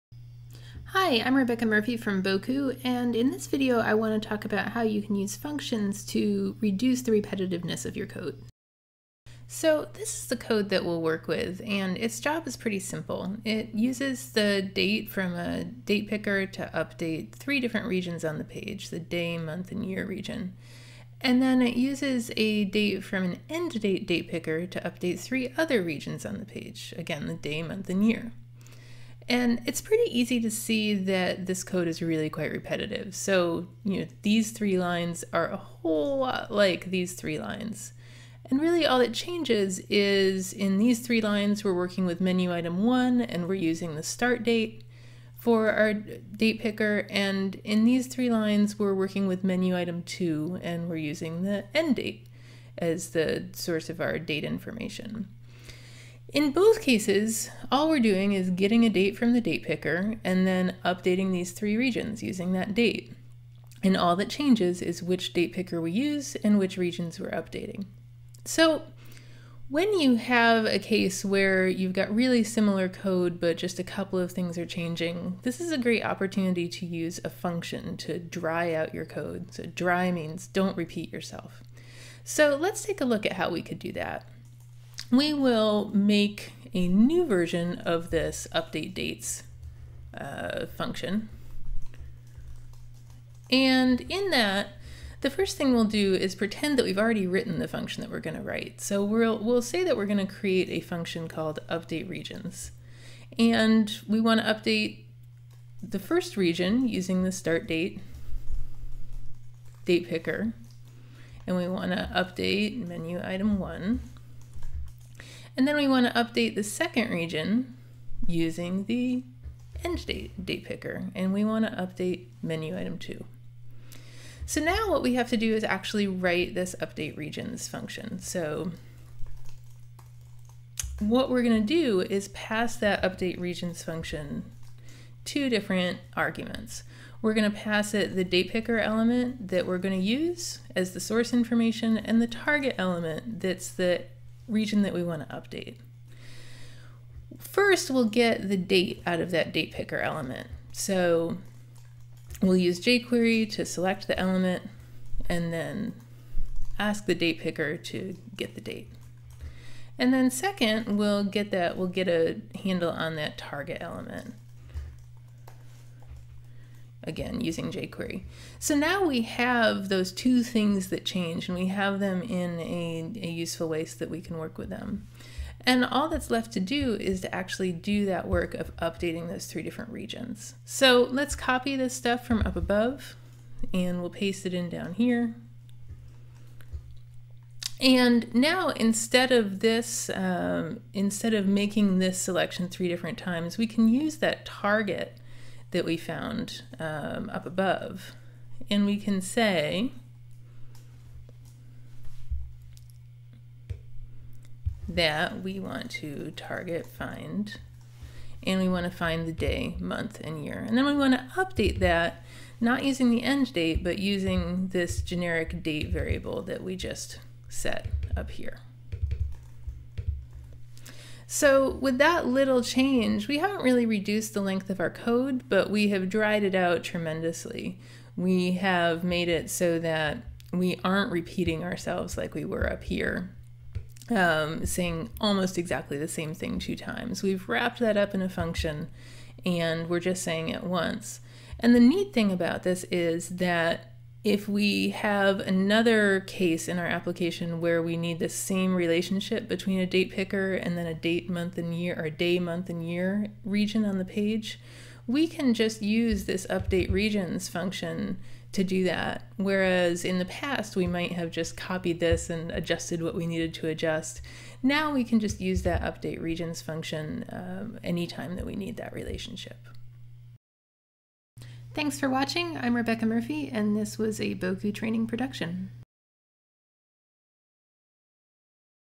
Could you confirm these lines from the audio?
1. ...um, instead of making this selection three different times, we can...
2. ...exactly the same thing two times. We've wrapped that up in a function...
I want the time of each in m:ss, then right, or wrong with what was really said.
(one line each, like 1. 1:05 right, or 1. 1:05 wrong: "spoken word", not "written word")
1. 3:10 right
2. 3:55 right.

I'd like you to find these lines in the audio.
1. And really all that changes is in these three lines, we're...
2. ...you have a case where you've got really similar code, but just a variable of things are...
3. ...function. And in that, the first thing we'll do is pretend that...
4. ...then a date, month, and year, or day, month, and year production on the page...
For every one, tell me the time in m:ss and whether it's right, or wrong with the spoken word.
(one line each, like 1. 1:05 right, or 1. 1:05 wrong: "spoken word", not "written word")
1. 0:38 right
2. 1:09 wrong: "couple", not "variable"
3. 1:30 right
4. 4:10 wrong: "region", not "production".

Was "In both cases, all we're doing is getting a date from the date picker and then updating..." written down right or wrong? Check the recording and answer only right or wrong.
right.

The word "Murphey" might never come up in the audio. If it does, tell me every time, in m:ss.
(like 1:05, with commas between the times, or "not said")
0:01, 4:33.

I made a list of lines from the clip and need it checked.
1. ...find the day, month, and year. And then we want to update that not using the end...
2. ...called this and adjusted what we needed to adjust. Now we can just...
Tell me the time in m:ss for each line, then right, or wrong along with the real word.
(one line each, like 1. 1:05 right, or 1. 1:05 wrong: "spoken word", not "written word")
1. 3:28 right
2. 4:21 wrong: "copied", not "called".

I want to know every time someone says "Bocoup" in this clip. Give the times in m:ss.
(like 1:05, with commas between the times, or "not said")
0:02, 4:34.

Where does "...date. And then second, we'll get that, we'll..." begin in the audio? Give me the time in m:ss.
2:38.